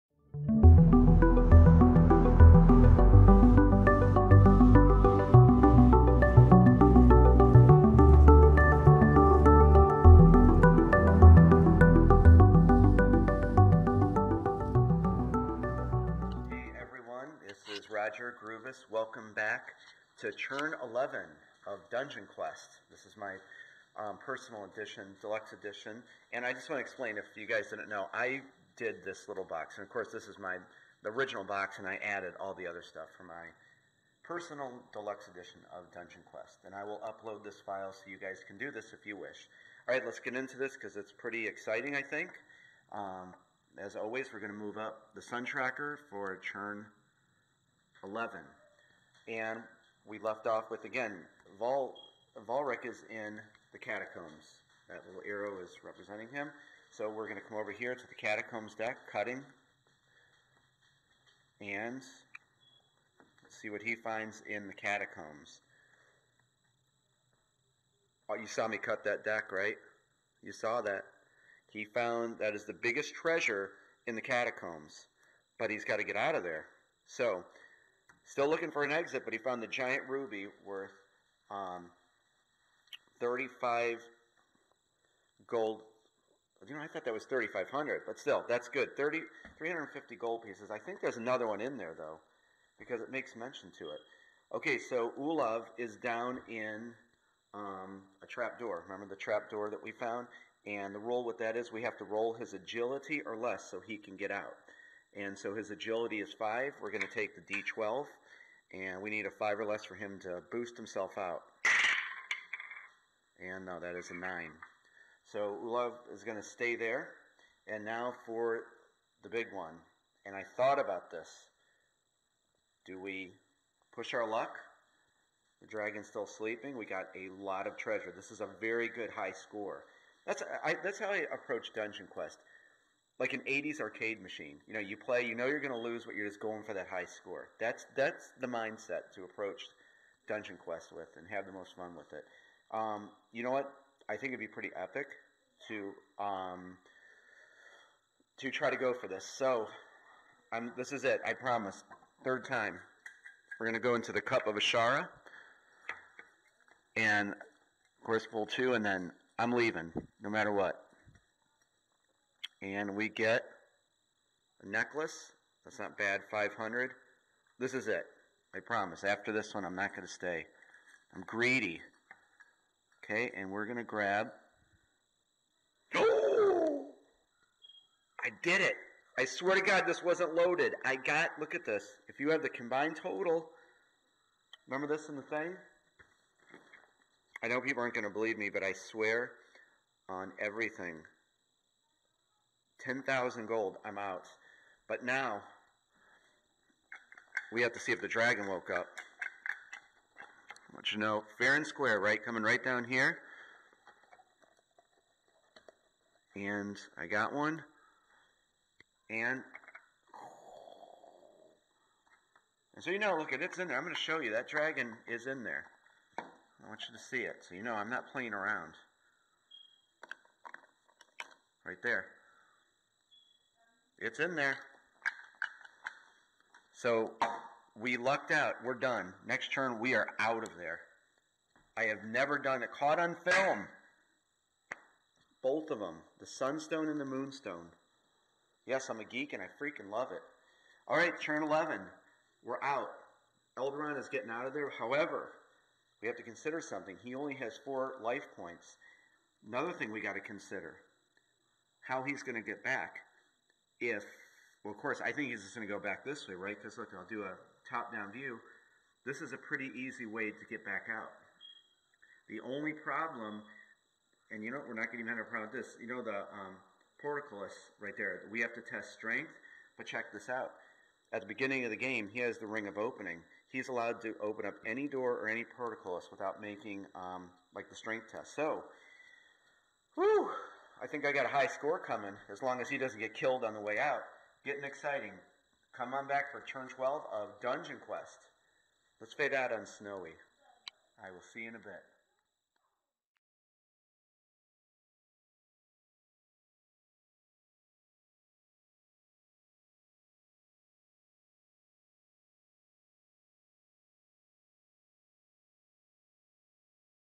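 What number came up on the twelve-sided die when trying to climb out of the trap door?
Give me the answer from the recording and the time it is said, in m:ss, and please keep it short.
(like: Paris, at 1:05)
9, at 1:53.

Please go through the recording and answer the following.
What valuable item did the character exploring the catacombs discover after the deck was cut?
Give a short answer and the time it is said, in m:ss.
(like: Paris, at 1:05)
giant ruby, at 1:19.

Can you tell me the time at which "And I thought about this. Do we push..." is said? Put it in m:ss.
2:00.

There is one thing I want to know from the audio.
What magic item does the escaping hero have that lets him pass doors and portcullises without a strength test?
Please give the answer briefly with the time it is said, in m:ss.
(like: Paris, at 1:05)
ring of opening, at 4:32.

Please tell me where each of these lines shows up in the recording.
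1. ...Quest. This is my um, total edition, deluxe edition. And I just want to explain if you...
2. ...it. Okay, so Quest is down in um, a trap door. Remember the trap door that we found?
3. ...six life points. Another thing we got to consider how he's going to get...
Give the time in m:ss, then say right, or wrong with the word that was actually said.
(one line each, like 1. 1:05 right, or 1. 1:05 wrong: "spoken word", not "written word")
1. 0:22 wrong: "personal", not "total"
2. 1:33 wrong: "Ulov", not "Quest"
3. 4:07 wrong: "four", not "six".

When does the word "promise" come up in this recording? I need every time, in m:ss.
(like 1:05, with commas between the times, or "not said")
2:31, 2:48.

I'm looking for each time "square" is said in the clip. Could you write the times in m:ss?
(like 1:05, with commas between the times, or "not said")
3:21.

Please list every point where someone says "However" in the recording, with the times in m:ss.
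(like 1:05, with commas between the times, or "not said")
4:04.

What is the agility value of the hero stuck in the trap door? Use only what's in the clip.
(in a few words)
5.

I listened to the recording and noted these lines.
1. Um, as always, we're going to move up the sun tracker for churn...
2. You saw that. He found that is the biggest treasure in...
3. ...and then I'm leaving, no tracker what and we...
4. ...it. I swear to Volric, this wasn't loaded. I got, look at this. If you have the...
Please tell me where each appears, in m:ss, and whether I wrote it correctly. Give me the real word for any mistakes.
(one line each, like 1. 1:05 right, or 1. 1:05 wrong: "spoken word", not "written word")
1. 0:42 right
2. 1:10 right
3. 2:38 wrong: "matter", not "tracker"
4. 2:58 wrong: "God", not "Volric".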